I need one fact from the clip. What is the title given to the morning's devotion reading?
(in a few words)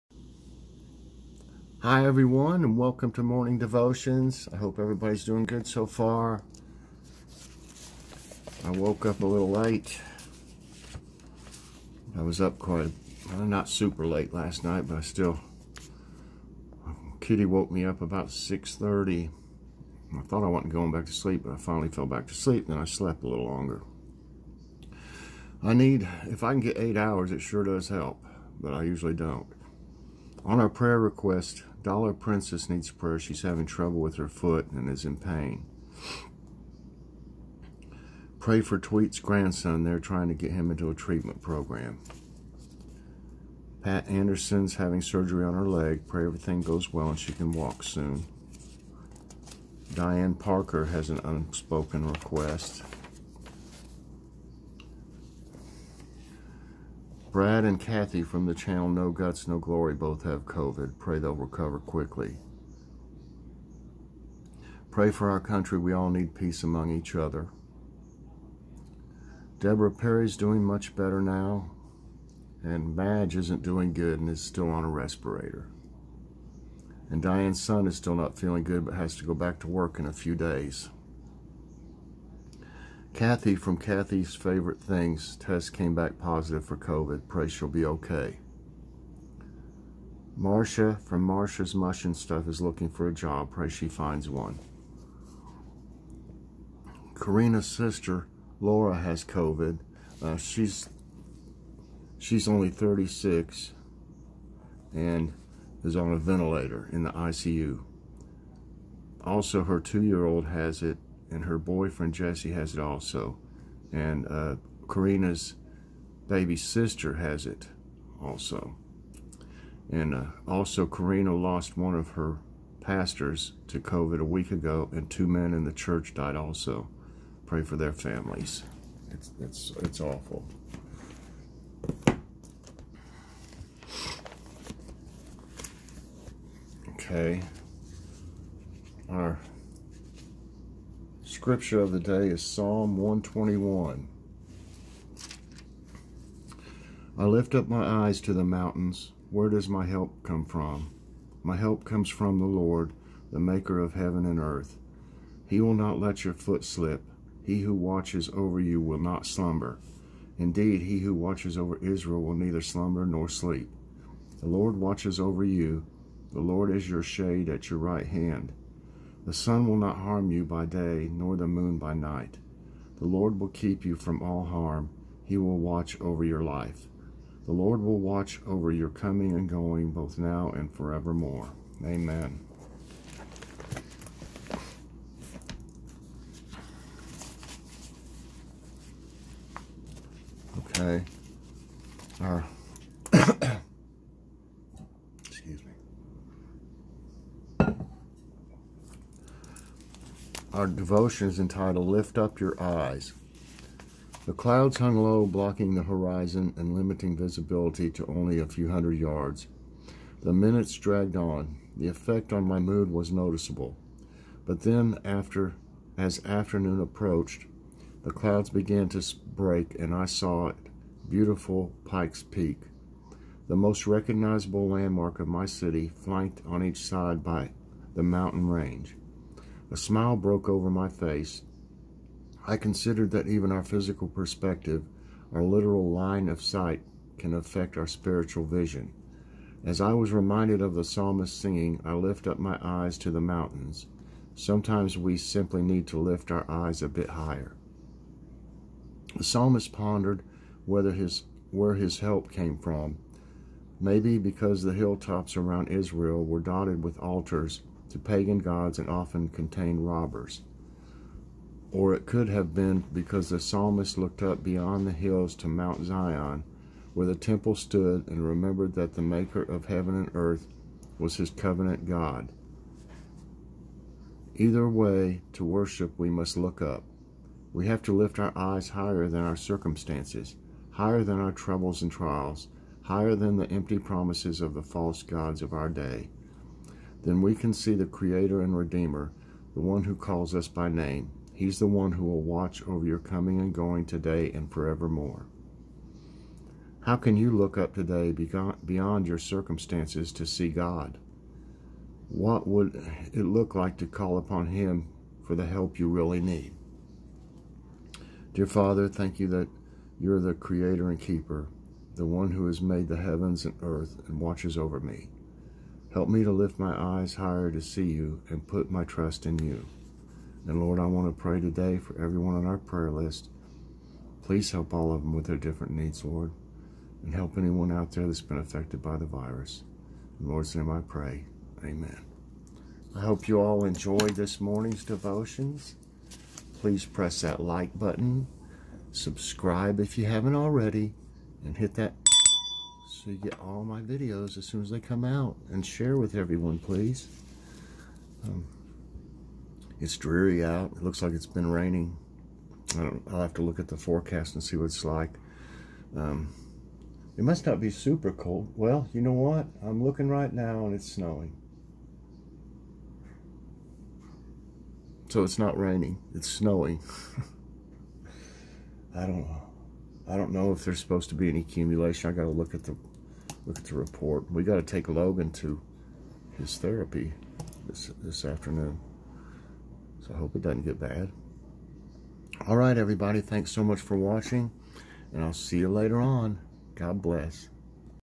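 Lift Up Your Eyes.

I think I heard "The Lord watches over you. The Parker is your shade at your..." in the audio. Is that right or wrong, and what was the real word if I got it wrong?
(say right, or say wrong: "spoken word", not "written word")
wrong: "Lord", not "Parker".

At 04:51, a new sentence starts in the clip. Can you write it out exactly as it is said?
He's the one who will watch over your coming and going today and forevermore.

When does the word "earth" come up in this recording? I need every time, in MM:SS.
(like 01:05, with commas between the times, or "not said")
02:34, 04:30, 05:13.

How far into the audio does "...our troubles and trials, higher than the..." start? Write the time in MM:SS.
04:41.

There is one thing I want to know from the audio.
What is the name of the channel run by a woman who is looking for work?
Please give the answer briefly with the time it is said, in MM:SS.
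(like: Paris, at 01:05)
Marcia's Mush and Stuff, at 01:31.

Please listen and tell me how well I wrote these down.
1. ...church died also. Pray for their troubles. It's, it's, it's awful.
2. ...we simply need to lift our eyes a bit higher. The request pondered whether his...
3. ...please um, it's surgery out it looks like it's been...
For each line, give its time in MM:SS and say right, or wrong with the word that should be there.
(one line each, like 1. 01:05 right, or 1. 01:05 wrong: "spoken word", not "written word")
1. 02:05 wrong: "families", not "troubles"
2. 04:04 wrong: "psalmist", not "request"
3. 05:46 wrong: "dreary", not "surgery".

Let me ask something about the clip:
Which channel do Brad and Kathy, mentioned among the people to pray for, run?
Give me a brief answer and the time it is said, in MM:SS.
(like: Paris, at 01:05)
No Guts, No Glory, at 00:58.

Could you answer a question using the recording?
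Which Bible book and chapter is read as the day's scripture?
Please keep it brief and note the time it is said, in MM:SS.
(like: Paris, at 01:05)
Psalm 121, at 02:22.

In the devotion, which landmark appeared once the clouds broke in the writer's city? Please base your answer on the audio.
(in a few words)
Pikes Peak.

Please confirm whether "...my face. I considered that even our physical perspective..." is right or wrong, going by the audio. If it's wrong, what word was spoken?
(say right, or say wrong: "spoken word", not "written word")
right.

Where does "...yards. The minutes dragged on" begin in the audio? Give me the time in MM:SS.
03:28.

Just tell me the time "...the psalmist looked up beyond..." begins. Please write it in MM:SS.
04:23.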